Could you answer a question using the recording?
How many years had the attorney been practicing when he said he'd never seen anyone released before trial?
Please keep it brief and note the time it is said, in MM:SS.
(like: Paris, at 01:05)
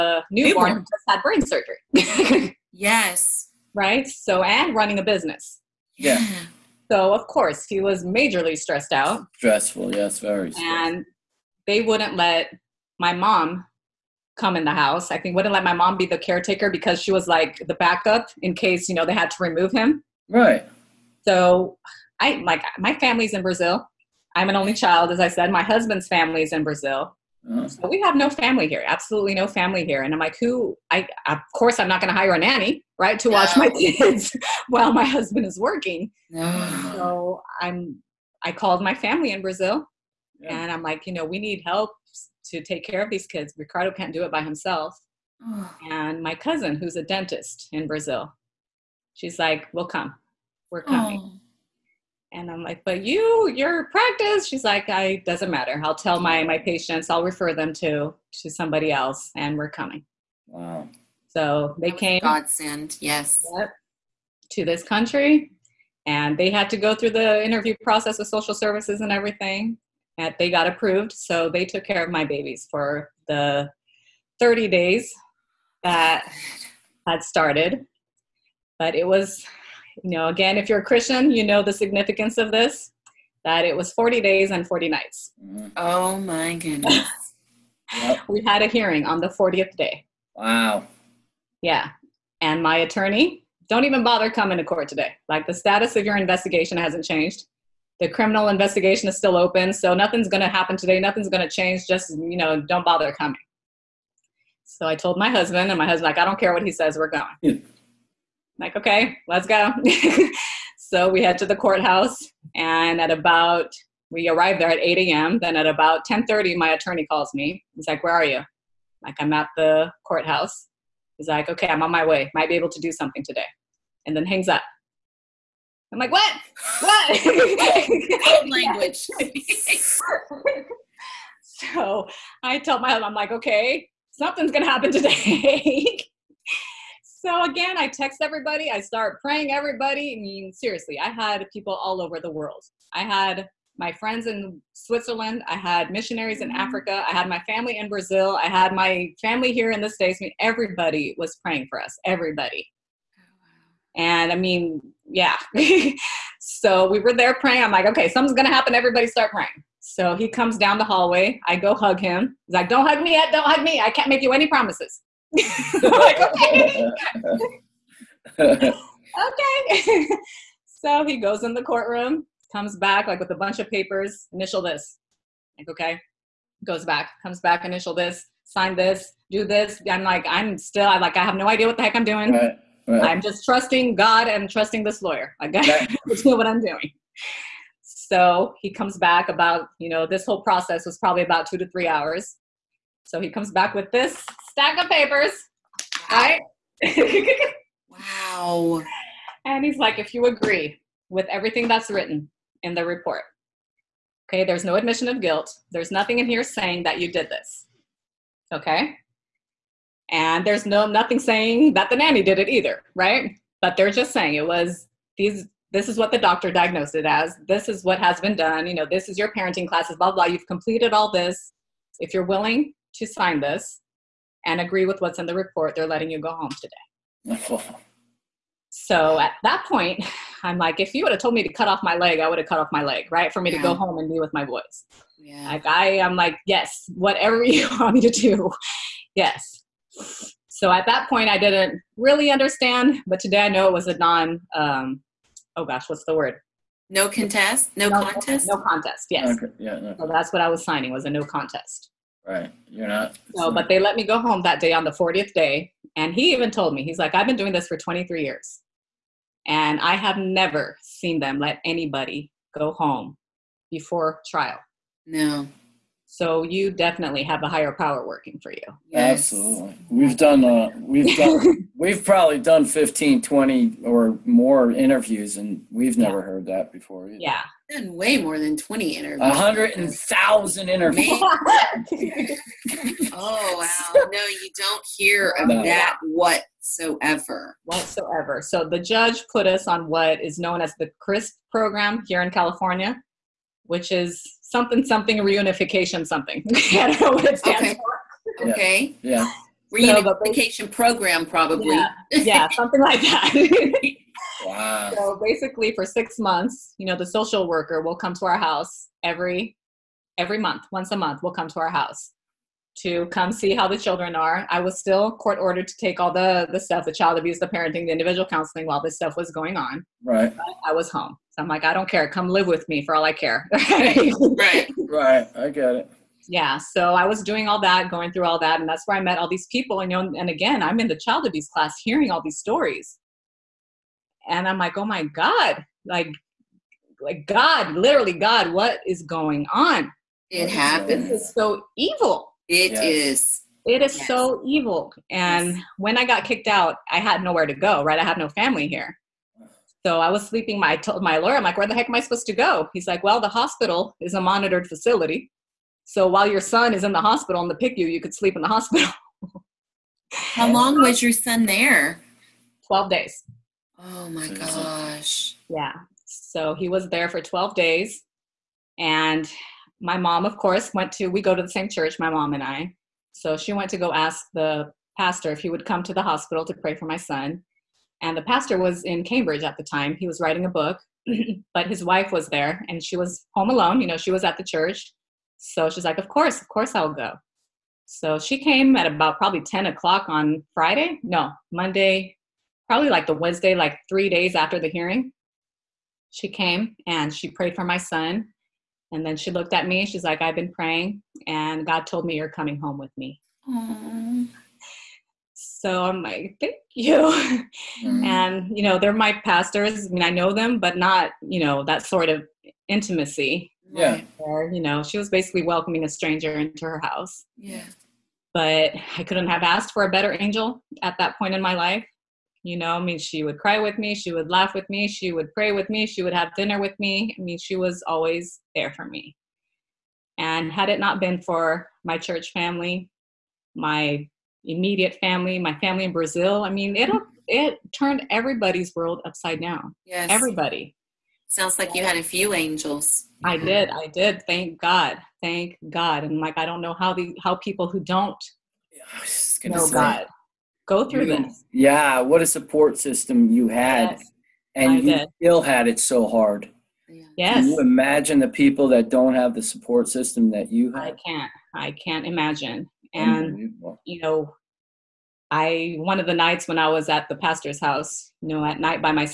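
23, at 04:17.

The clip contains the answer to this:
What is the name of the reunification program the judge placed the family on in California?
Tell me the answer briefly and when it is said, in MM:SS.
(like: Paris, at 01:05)
CRISP, at 04:50.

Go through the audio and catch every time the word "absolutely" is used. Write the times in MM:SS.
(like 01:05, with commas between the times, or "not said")
00:28, 04:29.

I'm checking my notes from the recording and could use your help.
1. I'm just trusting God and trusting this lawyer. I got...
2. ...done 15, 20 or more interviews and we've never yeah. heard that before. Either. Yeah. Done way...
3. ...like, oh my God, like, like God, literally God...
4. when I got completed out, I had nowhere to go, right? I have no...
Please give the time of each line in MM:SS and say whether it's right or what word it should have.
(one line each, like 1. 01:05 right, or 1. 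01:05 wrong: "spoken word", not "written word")
1. 03:03 right
2. 04:32 right
3. 05:34 right
4. 05:45 wrong: "kicked", not "completed".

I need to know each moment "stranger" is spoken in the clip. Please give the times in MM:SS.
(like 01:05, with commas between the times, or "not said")
06:55.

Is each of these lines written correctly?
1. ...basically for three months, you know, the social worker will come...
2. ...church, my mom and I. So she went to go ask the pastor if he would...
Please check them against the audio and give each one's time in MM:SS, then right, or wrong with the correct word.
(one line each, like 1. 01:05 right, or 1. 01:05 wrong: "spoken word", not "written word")
1. 05:05 wrong: "six", not "three"
2. 06:11 right.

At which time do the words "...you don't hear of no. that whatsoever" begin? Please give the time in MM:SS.
04:44.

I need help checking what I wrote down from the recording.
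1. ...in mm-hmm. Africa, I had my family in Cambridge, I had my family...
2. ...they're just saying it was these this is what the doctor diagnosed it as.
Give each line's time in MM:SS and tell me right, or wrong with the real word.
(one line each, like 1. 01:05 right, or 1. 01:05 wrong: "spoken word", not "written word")
1. 02:26 wrong: "Brazil", not "Cambridge"
2. 03:33 right.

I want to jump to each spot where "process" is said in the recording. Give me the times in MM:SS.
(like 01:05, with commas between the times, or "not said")
01:07, 03:10.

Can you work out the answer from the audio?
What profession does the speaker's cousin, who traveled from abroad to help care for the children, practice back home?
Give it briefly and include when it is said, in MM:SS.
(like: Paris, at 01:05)
Dentist, at 00:47.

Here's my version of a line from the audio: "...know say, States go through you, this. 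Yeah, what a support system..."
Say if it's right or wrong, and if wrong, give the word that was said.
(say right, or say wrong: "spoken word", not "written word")
wrong: "God", not "States".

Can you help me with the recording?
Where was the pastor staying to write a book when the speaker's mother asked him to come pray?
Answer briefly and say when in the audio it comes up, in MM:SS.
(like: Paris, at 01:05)
Cambridge, at 06:19.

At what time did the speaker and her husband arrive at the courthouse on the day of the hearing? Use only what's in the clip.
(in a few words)
8 a.m.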